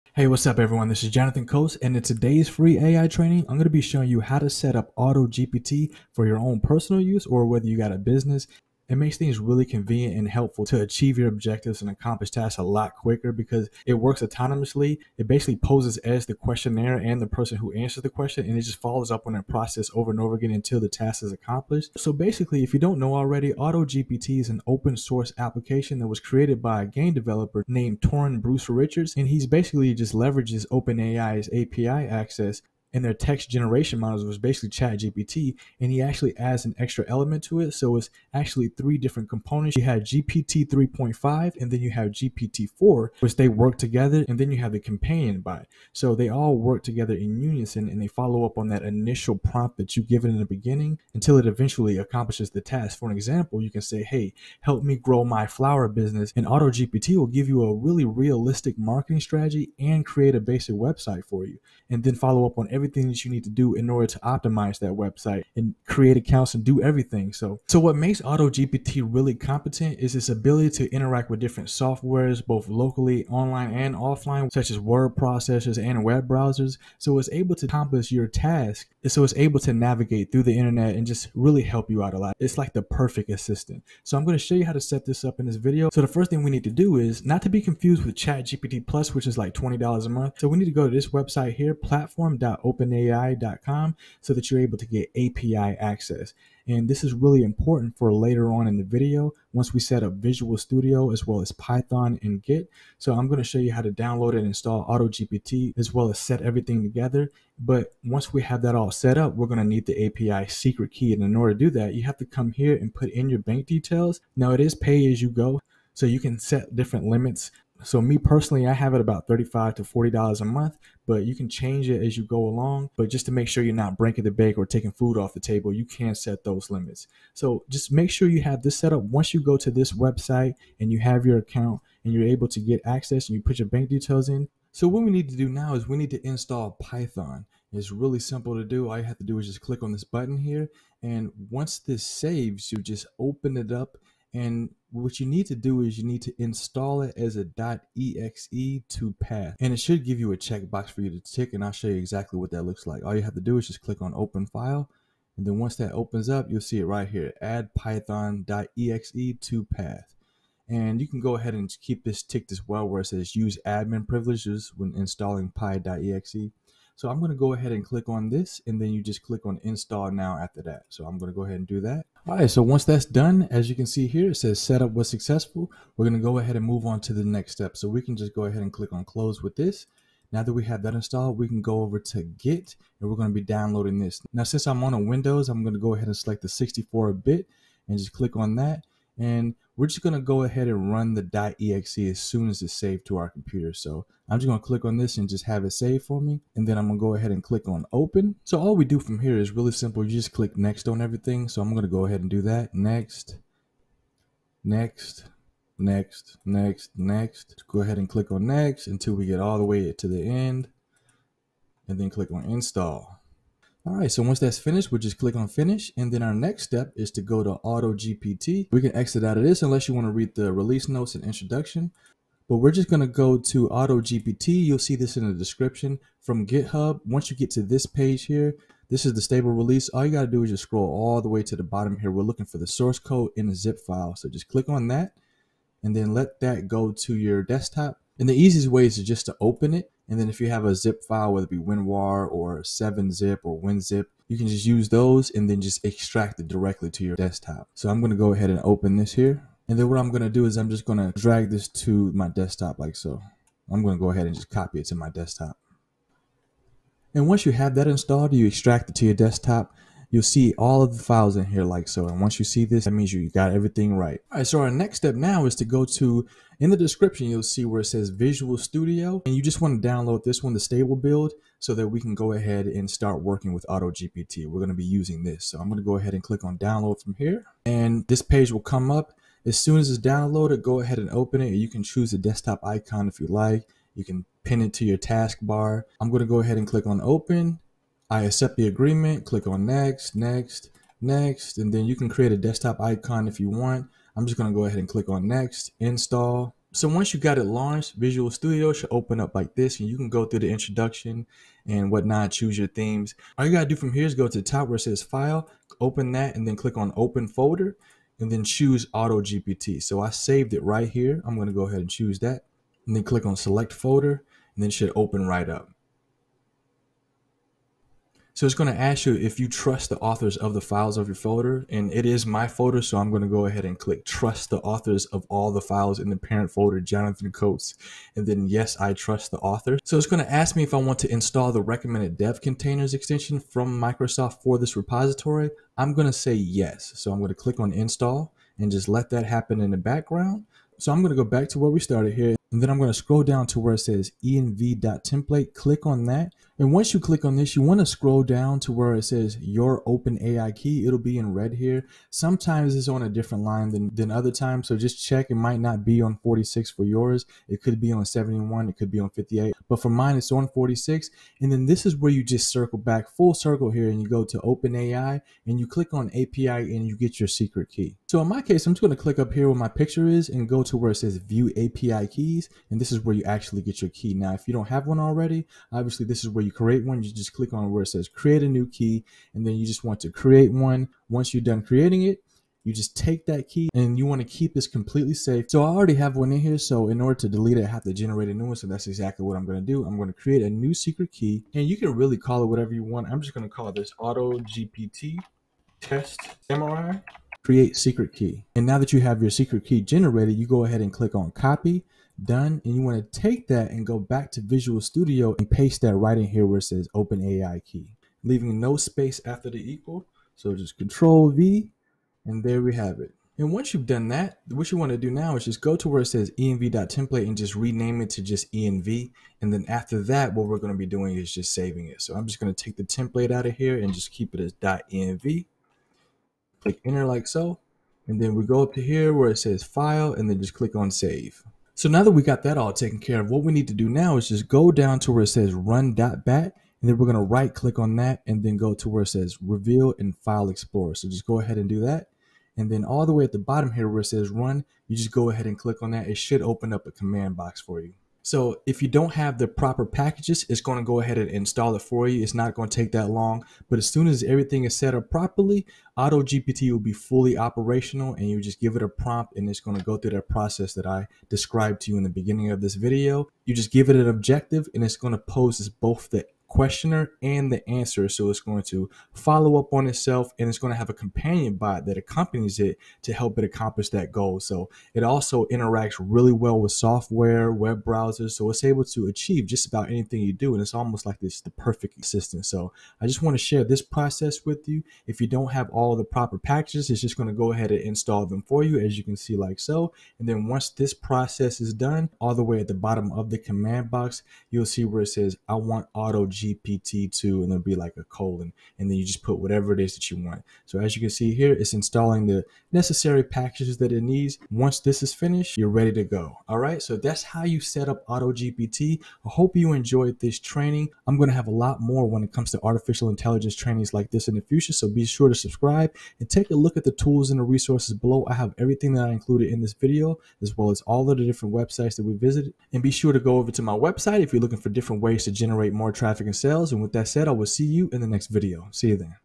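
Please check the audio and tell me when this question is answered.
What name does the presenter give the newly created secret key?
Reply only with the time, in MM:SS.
06:33.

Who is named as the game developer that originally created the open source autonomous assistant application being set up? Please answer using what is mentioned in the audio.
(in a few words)
Toran Bruce Richards.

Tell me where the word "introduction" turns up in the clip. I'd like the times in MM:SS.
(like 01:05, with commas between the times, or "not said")
03:41, 05:00.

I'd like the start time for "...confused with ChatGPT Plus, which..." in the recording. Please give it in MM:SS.
01:27.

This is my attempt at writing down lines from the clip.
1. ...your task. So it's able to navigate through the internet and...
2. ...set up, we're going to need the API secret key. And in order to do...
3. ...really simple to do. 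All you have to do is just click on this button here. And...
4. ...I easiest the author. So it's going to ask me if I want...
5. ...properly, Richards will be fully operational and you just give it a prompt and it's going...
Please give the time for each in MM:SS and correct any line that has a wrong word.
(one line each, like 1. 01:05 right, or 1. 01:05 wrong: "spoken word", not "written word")
1. 01:18 right
2. 01:48 right
3. 02:17 right
4. 05:28 wrong: "trust", not "easiest"
5. 07:35 wrong: "AutoGPT", not "Richards".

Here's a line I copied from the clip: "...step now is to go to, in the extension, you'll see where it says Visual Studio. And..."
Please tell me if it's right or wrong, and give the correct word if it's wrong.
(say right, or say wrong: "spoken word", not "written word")
wrong: "description", not "extension".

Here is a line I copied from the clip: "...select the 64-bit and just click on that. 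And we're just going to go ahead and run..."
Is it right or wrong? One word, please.
right.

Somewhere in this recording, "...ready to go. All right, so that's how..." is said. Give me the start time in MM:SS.
08:25.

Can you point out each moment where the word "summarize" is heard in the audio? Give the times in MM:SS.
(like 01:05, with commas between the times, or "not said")
not said.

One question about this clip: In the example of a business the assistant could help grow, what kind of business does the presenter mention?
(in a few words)
flower business.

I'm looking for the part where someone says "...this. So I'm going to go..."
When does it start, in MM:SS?
04:35.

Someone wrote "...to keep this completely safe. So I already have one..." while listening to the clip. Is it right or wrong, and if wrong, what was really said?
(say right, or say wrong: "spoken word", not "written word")
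right.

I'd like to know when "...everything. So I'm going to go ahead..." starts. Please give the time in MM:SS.
03:21.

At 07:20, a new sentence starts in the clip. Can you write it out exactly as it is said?
So just go ahead and do that.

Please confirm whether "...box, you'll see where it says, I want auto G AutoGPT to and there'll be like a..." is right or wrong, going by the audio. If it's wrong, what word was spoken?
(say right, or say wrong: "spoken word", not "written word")
wrong: "GPT", not "AutoGPT".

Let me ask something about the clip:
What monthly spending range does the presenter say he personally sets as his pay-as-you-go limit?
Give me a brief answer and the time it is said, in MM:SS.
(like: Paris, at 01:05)
$35 to $40, at 01:59.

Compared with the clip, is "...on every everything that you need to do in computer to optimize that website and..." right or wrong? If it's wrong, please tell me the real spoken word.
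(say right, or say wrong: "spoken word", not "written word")
wrong: "order", not "computer".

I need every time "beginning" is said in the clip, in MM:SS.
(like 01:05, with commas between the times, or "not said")
00:50, 07:42.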